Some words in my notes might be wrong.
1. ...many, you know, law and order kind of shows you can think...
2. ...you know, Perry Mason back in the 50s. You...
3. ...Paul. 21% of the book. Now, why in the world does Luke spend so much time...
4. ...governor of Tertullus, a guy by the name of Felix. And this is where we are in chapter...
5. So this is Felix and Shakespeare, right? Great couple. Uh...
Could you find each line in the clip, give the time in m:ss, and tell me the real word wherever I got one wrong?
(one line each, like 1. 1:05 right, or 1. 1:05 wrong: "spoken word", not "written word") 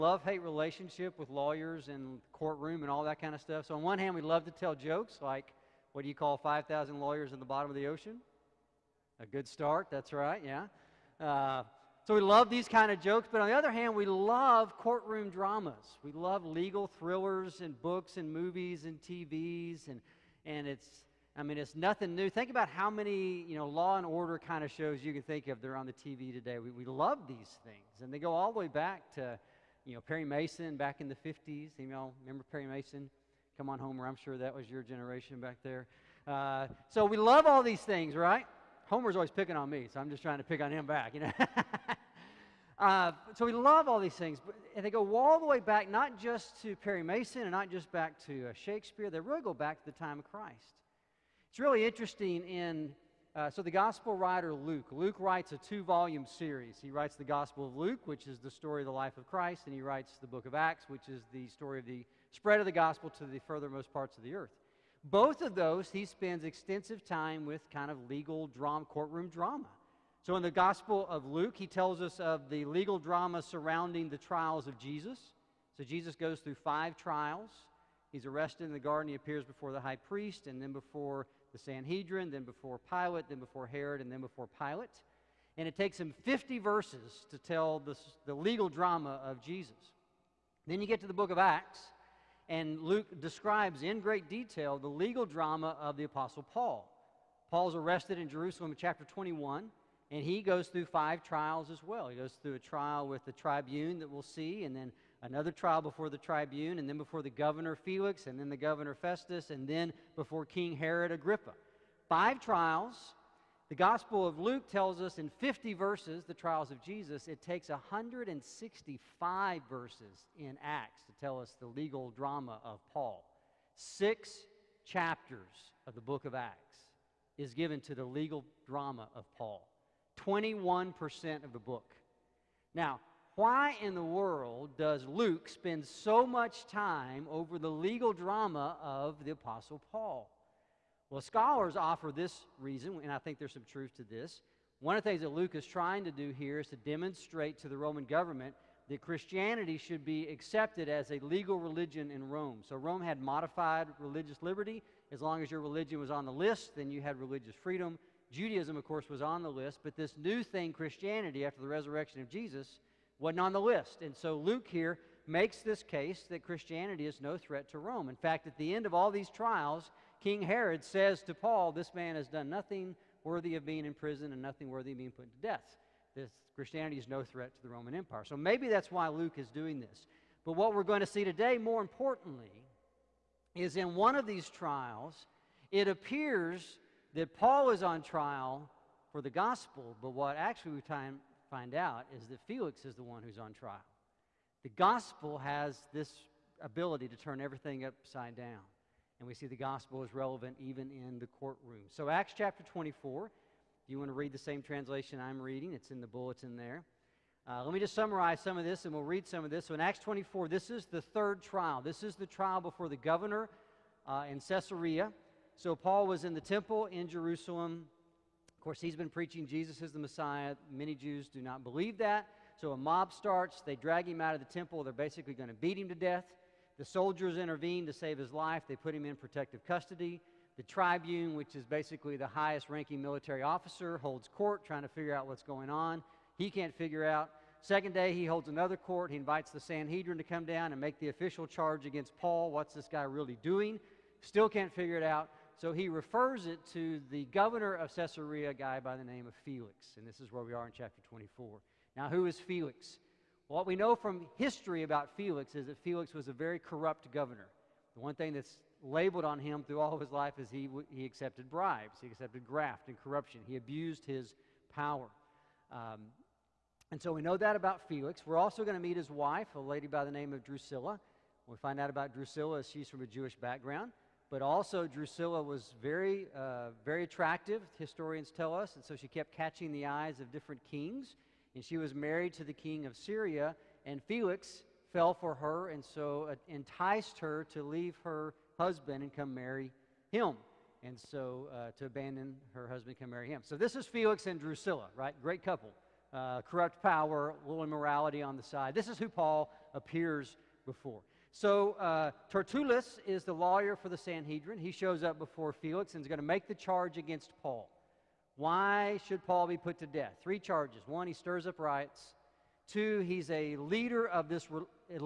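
1. 0:22 right
2. 0:29 right
3. 2:09 right
4. 4:07 wrong: "Caesarea", not "Tertullus"
5. 4:53 wrong: "Drusilla", not "Shakespeare".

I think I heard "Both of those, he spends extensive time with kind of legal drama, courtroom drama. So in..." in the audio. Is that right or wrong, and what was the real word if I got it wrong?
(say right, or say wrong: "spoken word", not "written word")
right.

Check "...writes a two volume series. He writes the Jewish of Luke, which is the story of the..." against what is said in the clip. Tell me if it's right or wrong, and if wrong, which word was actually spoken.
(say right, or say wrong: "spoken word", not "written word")
wrong: "Gospel", not "Jewish".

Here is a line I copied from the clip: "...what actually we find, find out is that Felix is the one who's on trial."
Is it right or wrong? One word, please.
right.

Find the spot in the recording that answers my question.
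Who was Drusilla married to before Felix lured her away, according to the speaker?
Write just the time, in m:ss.
4:42.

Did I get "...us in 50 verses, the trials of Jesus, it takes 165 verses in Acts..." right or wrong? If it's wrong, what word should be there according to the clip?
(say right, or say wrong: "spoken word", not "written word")
right.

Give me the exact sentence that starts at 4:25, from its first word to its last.
Um, and so we know that about Felix.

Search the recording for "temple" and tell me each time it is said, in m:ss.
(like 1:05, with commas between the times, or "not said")
3:36, 3:44.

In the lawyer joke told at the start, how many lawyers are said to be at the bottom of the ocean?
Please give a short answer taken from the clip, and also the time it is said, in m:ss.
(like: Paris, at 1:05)
5,000, at 0:06.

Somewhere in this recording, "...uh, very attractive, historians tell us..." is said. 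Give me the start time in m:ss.
4:36.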